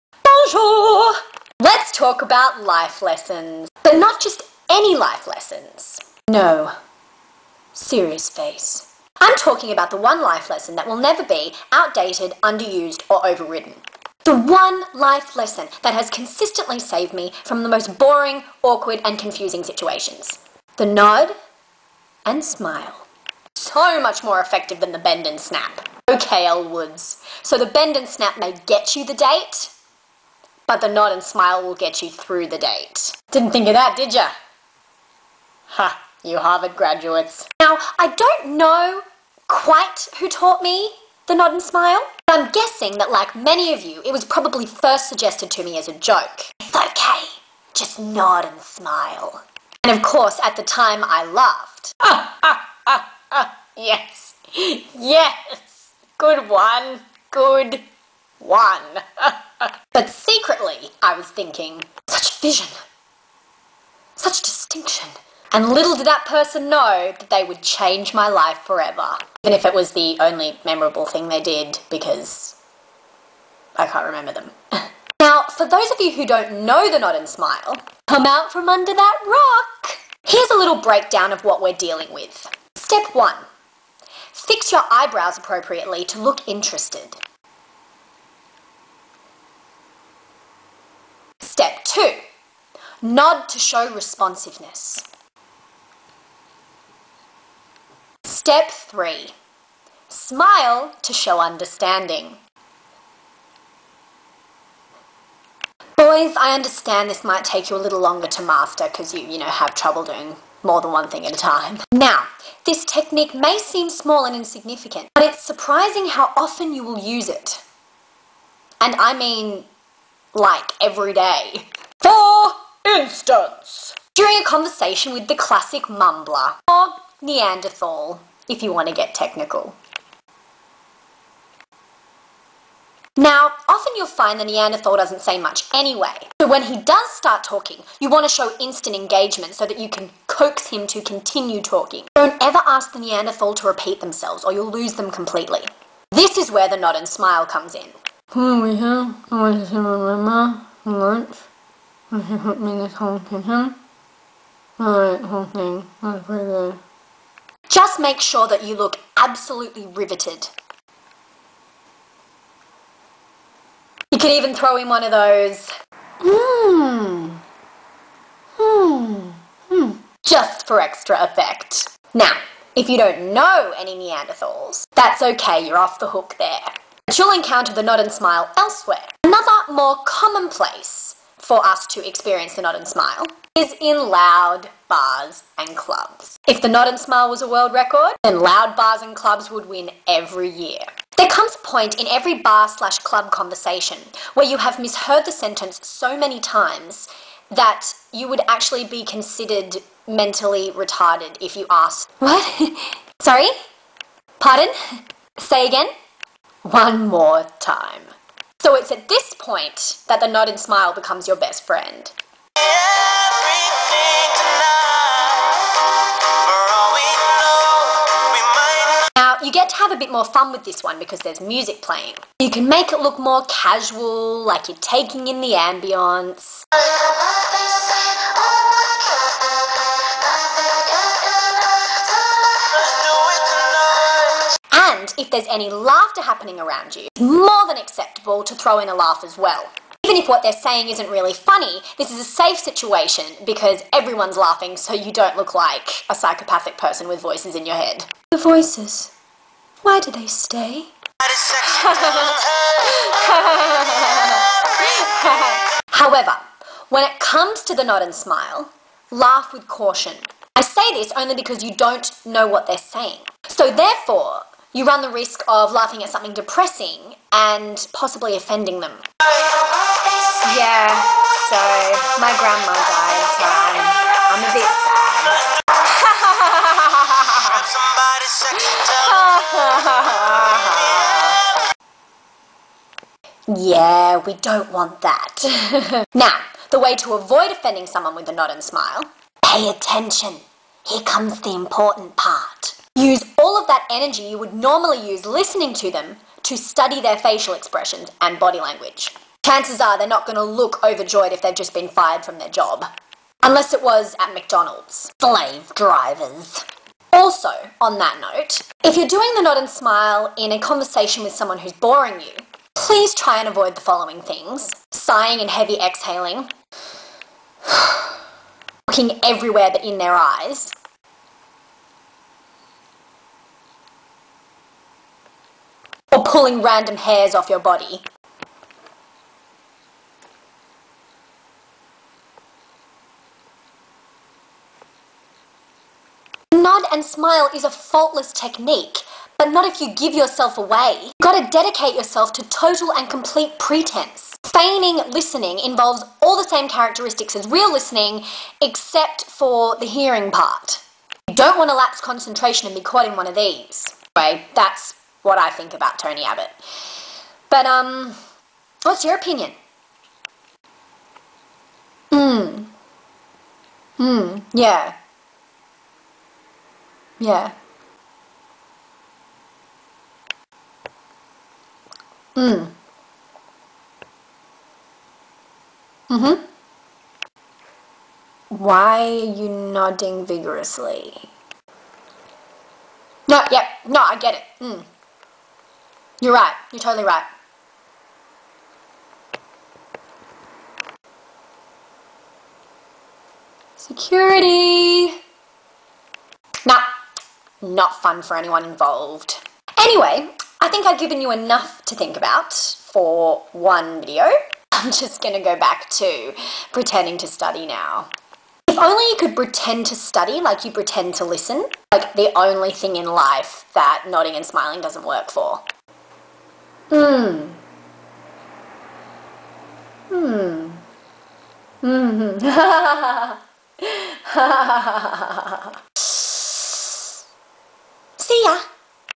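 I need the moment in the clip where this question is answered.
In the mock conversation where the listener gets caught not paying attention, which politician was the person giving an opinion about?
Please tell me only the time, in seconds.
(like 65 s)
355 s.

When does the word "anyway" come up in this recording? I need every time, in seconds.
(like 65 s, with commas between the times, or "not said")
135 s, 354 s, 399 s.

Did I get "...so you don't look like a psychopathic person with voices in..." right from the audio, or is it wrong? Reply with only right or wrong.
right.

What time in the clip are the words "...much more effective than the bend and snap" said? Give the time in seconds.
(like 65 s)
24 s.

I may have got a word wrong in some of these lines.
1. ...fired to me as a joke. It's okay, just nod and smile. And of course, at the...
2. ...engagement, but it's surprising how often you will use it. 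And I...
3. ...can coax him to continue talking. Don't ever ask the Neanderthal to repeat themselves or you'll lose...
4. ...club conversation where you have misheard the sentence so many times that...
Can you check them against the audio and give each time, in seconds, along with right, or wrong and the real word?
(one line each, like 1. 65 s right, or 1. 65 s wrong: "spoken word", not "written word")
1. 45 s wrong: "suggested", not "fired"
2. 114 s wrong: "insignificant", not "engagement"
3. 139 s right
4. 192 s right.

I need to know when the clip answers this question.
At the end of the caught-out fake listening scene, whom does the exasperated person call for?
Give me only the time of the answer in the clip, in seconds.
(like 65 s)
393 s.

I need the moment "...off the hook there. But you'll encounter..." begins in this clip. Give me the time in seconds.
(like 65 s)
175 s.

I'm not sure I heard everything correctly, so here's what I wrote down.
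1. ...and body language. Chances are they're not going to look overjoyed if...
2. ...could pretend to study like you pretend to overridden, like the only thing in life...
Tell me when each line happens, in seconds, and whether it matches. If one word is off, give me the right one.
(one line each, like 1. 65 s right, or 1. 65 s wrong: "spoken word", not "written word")
1. 298 s right
2. 409 s wrong: "listen", not "overridden".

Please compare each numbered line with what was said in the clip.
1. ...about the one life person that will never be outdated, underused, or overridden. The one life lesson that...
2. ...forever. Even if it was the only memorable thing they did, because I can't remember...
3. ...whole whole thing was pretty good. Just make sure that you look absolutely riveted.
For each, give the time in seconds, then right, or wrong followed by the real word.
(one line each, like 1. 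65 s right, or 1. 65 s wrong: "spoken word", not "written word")
1. 9 s wrong: "lesson", not "person"
2. 68 s right
3. 152 s right.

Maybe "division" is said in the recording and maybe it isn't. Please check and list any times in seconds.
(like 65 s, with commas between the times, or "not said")
not said.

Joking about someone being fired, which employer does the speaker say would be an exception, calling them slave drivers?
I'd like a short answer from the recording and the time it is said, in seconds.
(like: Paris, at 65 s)
McDonald's, at 304 s.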